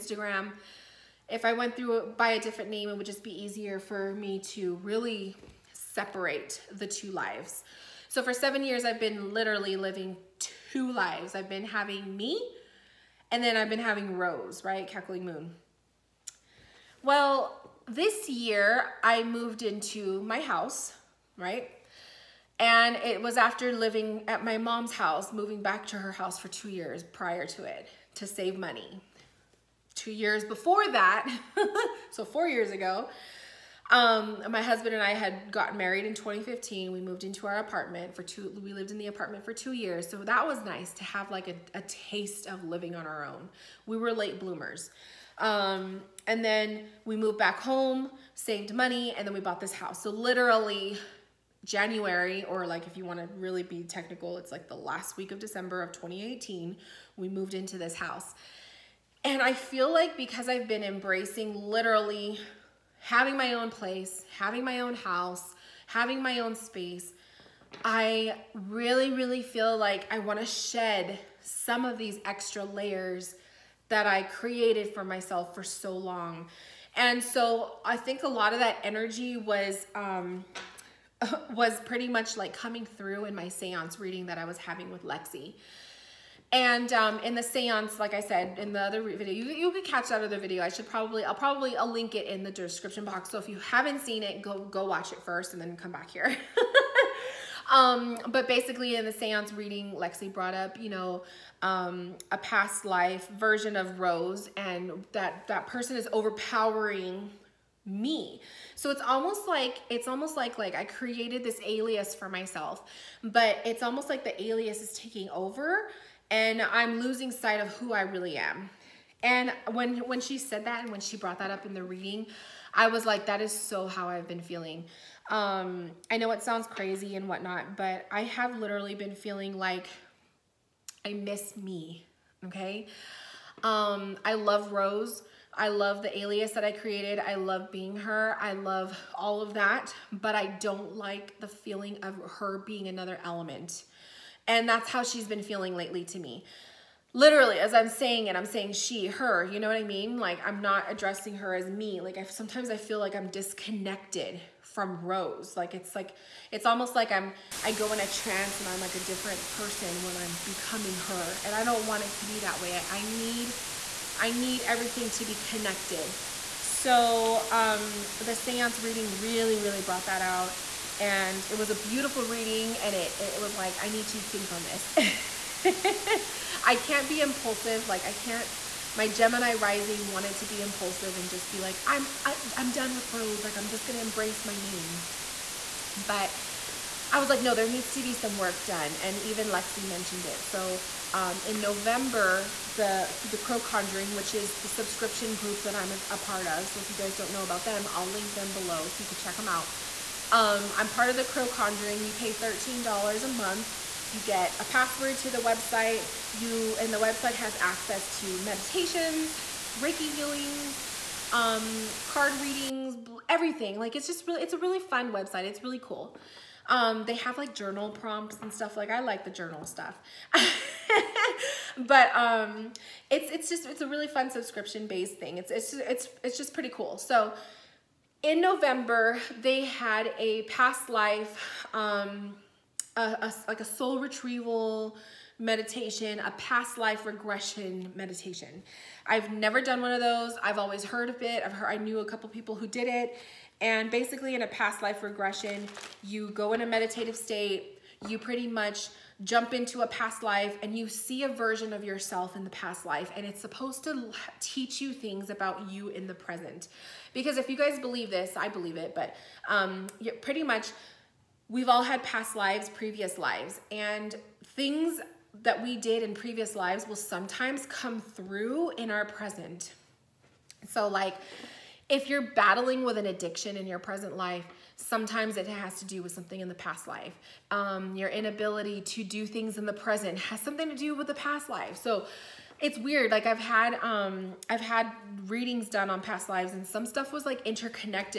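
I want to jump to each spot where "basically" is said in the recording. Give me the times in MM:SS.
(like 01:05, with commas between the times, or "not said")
01:38, 04:03.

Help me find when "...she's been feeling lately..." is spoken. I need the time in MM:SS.
02:25.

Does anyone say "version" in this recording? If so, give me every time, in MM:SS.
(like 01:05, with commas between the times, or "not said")
01:43, 04:11.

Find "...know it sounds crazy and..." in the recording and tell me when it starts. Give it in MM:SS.
02:06.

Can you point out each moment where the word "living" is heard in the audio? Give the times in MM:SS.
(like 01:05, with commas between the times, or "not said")
00:09, 00:23, 00:42.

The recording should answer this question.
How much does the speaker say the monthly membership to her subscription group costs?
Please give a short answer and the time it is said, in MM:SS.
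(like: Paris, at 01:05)
$13, at 03:22.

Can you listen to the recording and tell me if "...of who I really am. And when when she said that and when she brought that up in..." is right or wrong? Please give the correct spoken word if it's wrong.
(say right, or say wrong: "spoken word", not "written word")
right.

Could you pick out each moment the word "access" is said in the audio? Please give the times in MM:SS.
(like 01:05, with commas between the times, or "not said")
03:27.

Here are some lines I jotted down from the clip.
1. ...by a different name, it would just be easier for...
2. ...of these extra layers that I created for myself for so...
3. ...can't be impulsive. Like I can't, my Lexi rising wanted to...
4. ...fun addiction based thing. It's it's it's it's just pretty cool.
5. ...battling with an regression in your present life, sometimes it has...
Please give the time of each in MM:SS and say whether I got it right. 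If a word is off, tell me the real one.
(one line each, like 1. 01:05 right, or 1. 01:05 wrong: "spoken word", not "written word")
1. 00:02 right
2. 01:11 right
3. 02:56 wrong: "Gemini", not "Lexi"
4. 03:44 wrong: "subscription", not "addiction"
5. 04:32 wrong: "addiction", not "regression".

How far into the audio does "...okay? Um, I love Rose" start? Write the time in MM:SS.
02:12.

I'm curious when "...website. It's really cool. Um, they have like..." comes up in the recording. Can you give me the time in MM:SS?
03:35.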